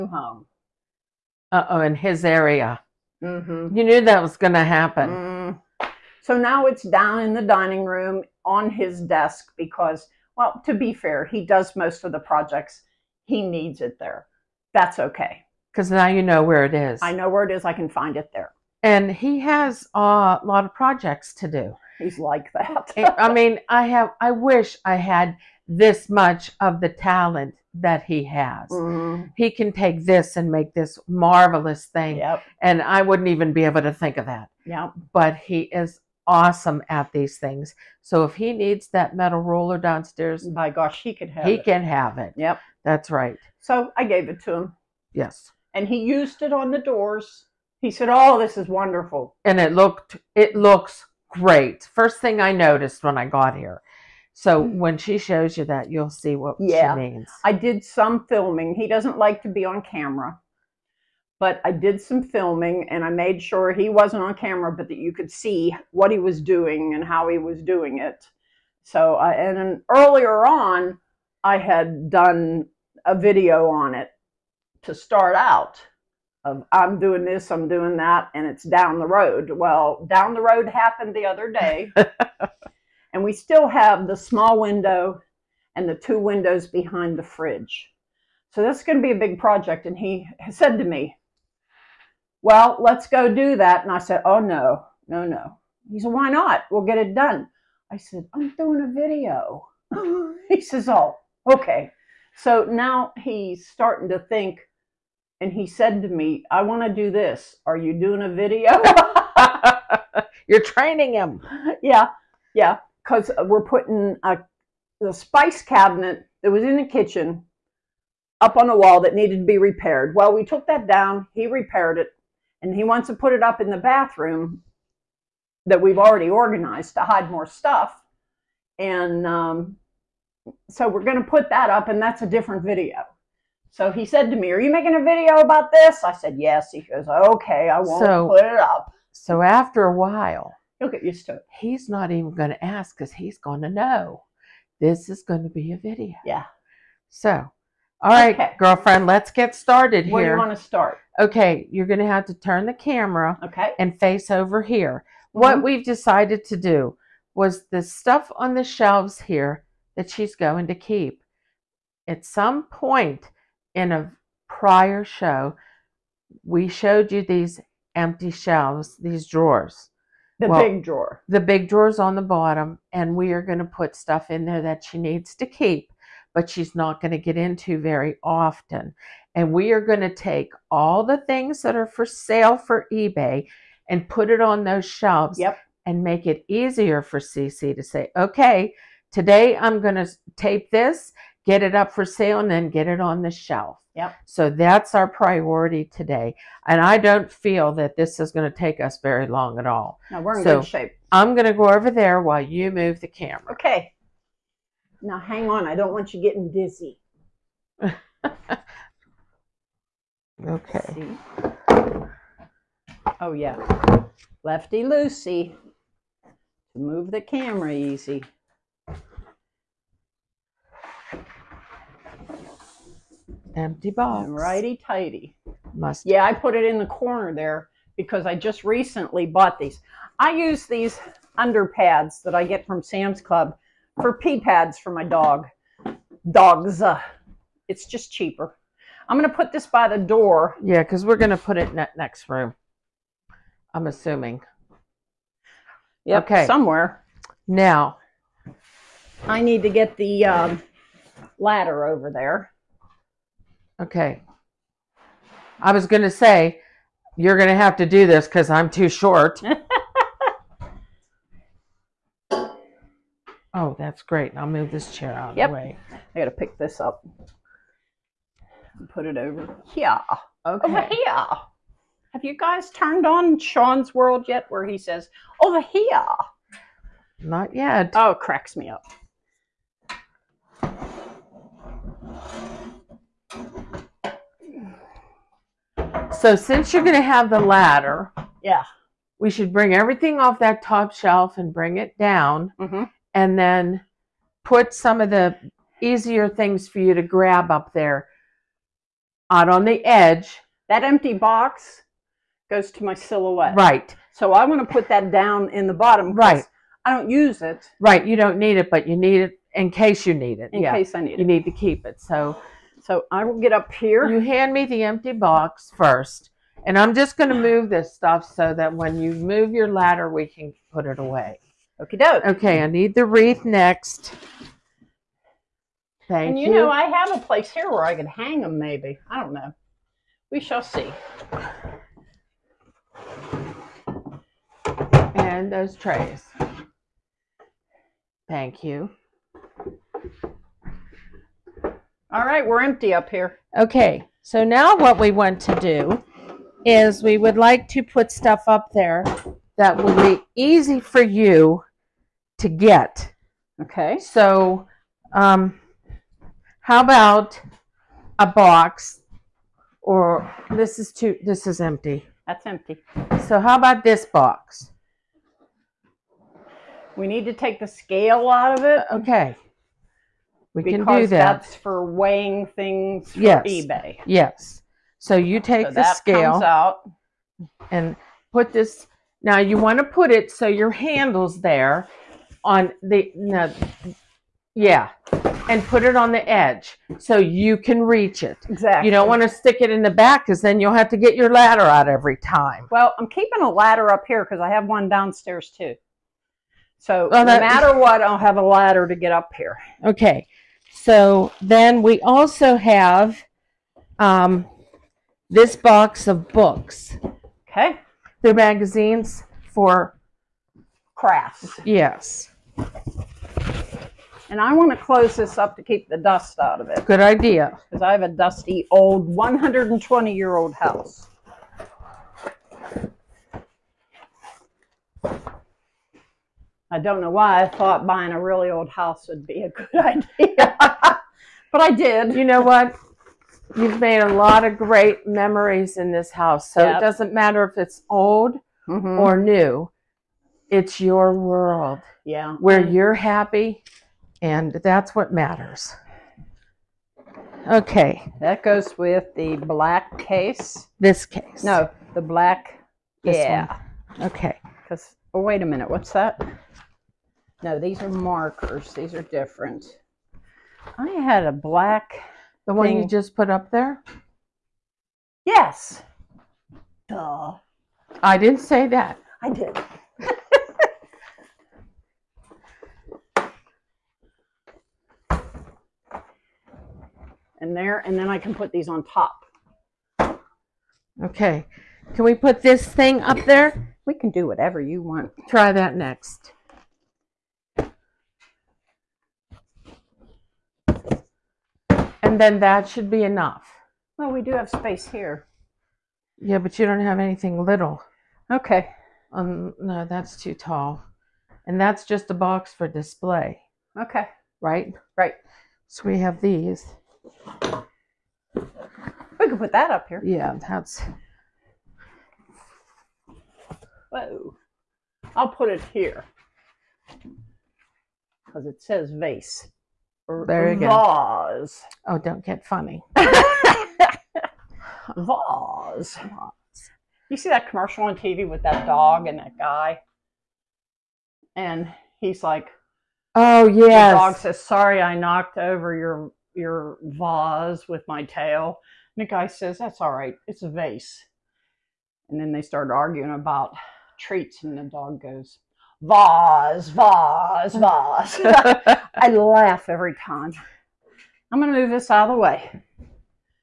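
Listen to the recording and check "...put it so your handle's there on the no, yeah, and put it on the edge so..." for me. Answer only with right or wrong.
right.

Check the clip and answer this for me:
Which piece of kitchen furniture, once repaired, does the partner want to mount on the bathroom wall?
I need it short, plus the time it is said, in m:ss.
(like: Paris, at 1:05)
Spice cabinet, at 1:55.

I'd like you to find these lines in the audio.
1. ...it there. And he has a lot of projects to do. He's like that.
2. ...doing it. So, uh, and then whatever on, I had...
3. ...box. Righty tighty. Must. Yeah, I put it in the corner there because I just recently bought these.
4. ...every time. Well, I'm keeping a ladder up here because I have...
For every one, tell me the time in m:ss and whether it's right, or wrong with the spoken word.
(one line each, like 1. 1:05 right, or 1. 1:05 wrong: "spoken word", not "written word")
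1. 0:18 right
2. 1:07 wrong: "earlier", not "whatever"
3. 3:43 right
4. 6:31 right.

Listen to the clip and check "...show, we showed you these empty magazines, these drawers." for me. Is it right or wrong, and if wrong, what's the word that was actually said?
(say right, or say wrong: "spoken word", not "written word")
wrong: "shelves", not "magazines".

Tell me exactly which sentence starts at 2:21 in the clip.
He's not even going to ask because he's going to know this is going to be a video.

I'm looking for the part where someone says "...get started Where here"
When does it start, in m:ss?
2:29.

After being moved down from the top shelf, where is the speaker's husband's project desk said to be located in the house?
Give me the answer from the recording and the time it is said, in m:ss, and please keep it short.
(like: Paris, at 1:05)
Dining room, at 0:07.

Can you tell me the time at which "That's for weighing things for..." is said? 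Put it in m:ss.
6:11.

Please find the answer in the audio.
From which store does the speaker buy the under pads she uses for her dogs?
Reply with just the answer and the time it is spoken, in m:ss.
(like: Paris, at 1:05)
Sam's Club, at 3:52.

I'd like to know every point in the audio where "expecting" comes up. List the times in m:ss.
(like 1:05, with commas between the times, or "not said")
not said.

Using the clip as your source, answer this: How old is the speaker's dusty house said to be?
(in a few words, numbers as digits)
120 years.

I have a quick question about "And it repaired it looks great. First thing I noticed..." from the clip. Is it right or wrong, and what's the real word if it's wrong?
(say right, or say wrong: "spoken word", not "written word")
wrong: "looked", not "repaired".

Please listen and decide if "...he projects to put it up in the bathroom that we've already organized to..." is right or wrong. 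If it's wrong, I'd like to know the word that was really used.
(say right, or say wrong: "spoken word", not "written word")
wrong: "wants", not "projects".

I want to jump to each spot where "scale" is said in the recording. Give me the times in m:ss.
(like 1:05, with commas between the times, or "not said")
6:07, 6:15.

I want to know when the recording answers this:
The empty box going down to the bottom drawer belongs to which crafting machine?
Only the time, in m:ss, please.
5:02.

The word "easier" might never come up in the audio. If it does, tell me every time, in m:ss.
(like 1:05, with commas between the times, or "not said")
3:06, 4:55.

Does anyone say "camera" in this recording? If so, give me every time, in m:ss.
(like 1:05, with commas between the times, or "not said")
0:59, 1:04, 2:32, 3:23, 3:37.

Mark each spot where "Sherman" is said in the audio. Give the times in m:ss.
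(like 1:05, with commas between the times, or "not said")
not said.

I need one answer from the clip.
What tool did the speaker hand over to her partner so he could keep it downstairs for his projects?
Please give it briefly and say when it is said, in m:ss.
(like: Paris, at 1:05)
Metal roller, at 0:39.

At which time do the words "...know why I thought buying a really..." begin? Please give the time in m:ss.
7:06.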